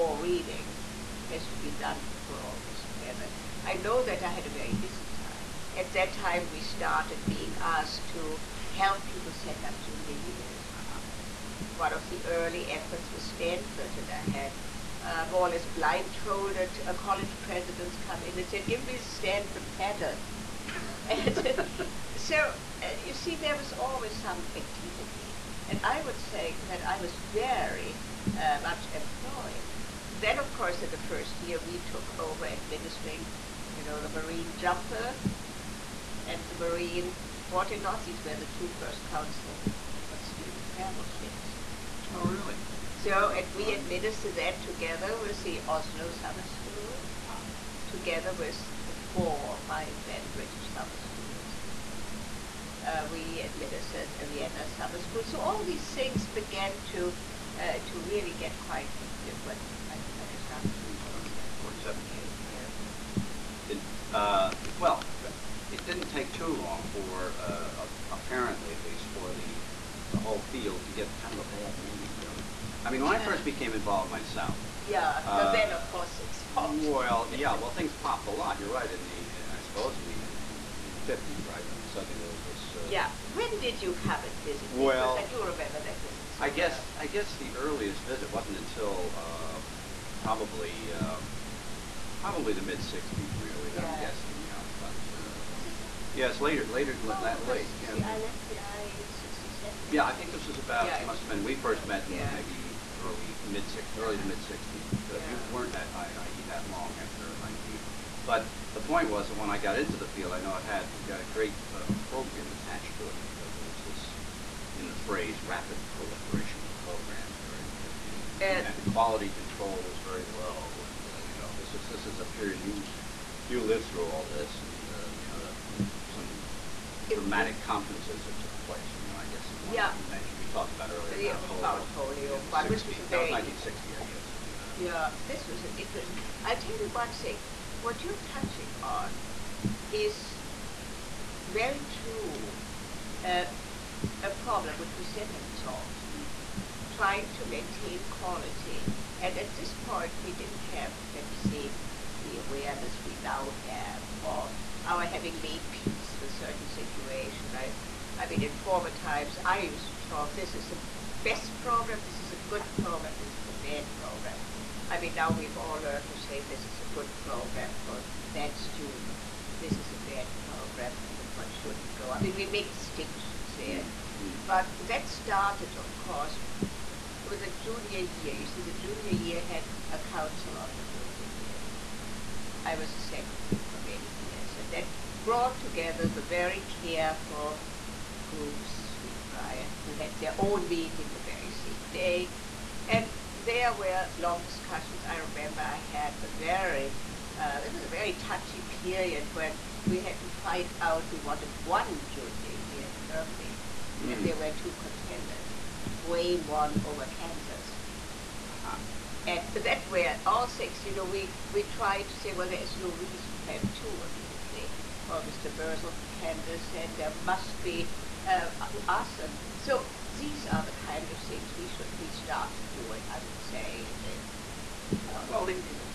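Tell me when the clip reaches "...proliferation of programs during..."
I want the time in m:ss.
1:55.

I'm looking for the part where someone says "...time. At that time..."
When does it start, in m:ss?
0:05.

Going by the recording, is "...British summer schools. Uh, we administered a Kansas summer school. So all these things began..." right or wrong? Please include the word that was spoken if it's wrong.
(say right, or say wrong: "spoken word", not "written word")
wrong: "Vienna", not "Kansas".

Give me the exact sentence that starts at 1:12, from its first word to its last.
I mean, when I first became involved myself.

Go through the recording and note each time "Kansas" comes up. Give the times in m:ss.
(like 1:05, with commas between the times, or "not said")
3:27, 3:36.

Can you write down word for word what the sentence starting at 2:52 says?
I mean, we make distinctions there.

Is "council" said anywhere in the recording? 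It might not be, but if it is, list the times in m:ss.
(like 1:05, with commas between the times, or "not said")
0:39, 2:59.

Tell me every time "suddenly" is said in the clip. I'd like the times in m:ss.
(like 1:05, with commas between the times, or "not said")
1:21.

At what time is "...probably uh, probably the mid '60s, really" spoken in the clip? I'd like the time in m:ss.
1:30.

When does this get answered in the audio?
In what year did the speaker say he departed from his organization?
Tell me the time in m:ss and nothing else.
1:39.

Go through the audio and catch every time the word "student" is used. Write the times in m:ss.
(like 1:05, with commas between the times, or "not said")
0:40, 2:48.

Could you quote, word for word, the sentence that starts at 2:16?
I'll tell you one thing what you're touching on is very true uh, a problem which we still haven't solved.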